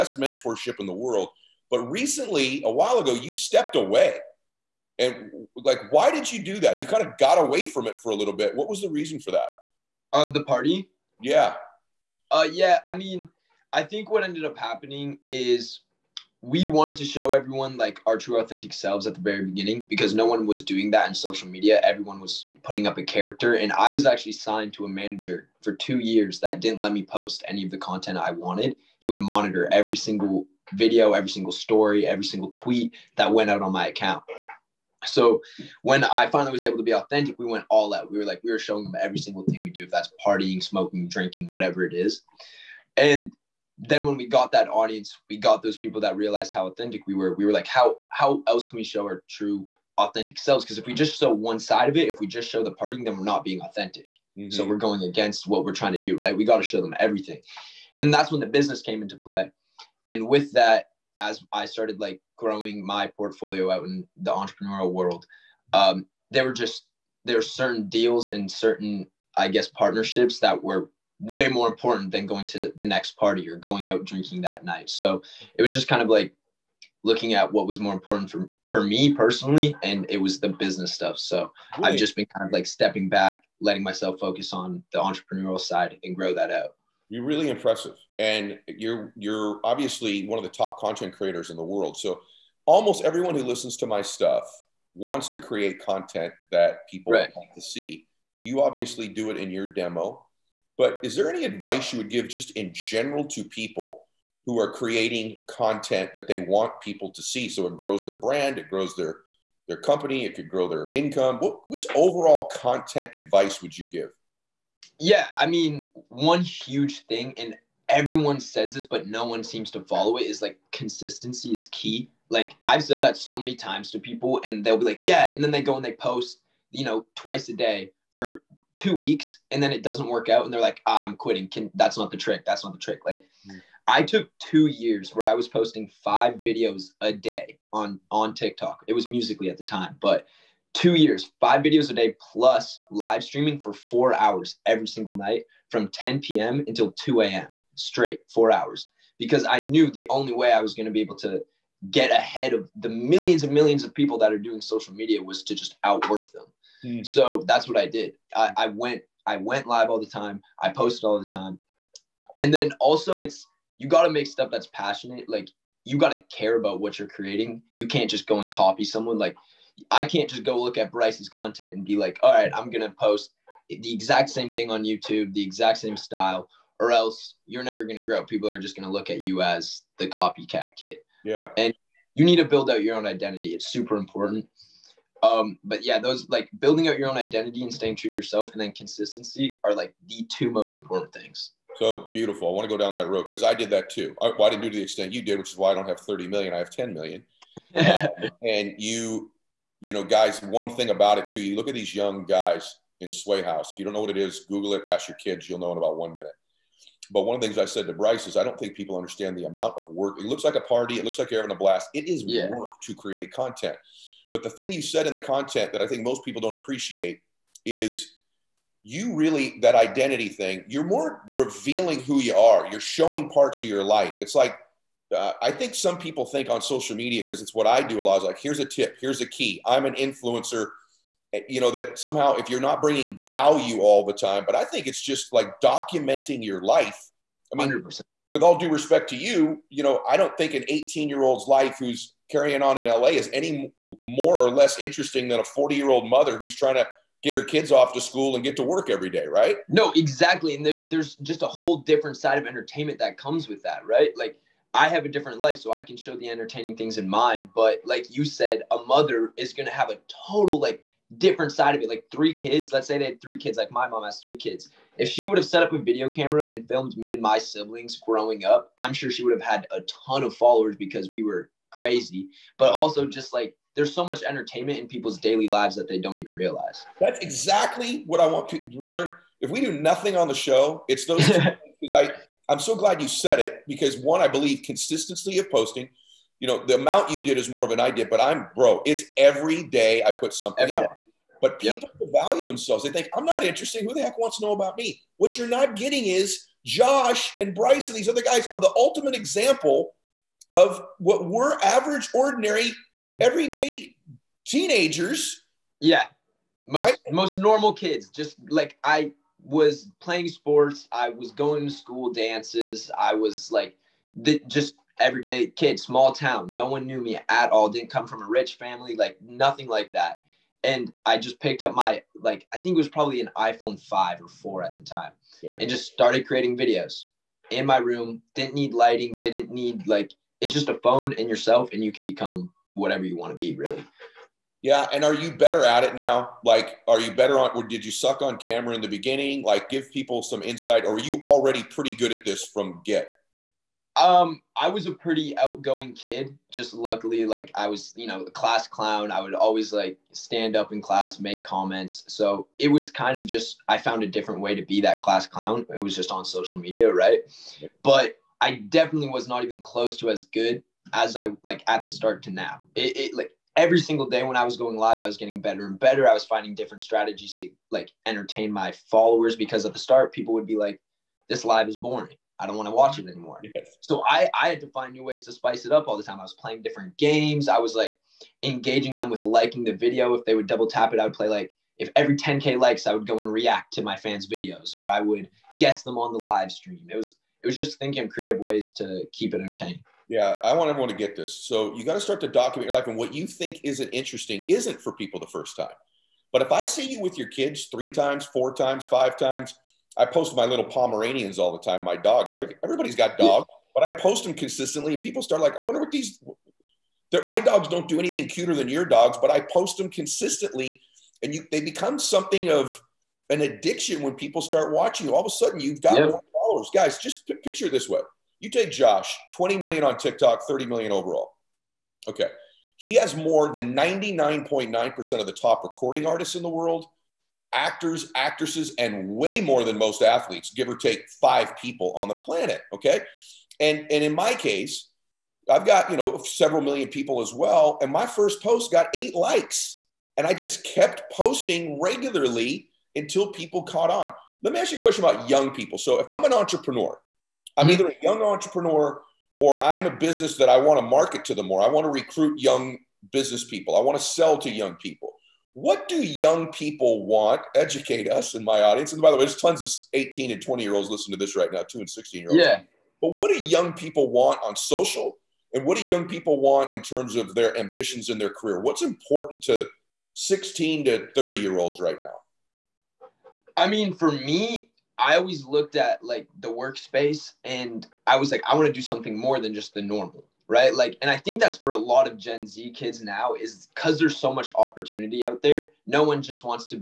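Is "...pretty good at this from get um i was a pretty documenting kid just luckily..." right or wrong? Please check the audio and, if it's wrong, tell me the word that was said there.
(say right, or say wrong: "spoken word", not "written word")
wrong: "outgoing", not "documenting".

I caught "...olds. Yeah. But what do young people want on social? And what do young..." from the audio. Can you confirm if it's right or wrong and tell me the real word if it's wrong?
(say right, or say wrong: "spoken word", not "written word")
right.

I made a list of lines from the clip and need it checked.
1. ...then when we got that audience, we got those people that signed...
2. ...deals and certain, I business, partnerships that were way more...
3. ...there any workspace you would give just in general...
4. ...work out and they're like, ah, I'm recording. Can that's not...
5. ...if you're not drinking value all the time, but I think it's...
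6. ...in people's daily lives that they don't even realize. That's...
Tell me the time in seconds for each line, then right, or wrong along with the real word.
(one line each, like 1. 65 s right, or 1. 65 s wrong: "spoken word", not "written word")
1. 43 s wrong: "realized", not "signed"
2. 67 s wrong: "guess", not "business"
3. 101 s wrong: "advice", not "workspace"
4. 130 s wrong: "quitting", not "recording"
5. 232 s wrong: "bringing", not "drinking"
6. 274 s right.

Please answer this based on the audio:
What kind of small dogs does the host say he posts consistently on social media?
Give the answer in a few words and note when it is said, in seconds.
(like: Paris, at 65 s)
Pomeranians, at 400 s.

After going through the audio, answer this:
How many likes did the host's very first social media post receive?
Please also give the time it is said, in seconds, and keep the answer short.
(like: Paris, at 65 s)
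8, at 438 s.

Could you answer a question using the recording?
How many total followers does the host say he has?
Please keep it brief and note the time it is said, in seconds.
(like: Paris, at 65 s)
10 million, at 196 s.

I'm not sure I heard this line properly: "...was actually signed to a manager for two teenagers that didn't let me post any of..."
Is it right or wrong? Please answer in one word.
wrong.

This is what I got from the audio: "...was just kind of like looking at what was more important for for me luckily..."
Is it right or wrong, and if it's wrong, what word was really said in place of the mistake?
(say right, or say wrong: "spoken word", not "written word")
wrong: "personally", not "luckily".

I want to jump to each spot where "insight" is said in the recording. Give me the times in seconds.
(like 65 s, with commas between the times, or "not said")
340 s.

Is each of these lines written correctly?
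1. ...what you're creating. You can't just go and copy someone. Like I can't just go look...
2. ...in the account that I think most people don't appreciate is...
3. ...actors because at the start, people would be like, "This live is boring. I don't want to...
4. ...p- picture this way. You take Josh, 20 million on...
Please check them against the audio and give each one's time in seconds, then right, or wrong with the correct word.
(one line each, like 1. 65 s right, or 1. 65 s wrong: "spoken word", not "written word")
1. 166 s right
2. 215 s wrong: "content", not "account"
3. 368 s wrong: "followers", not "actors"
4. 417 s right.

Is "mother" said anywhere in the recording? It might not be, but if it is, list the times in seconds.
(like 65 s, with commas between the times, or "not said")
246 s, 258 s.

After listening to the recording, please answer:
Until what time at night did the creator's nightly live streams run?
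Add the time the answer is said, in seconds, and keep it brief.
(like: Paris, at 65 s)
2 a.m., at 146 s.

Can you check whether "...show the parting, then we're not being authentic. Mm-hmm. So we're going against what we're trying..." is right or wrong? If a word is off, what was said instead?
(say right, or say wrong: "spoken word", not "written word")
right.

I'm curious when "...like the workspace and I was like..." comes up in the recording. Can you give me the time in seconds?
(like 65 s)
476 s.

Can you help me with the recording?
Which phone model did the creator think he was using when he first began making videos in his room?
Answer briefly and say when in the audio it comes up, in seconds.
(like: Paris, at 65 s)
iPhone 5, at 323 s.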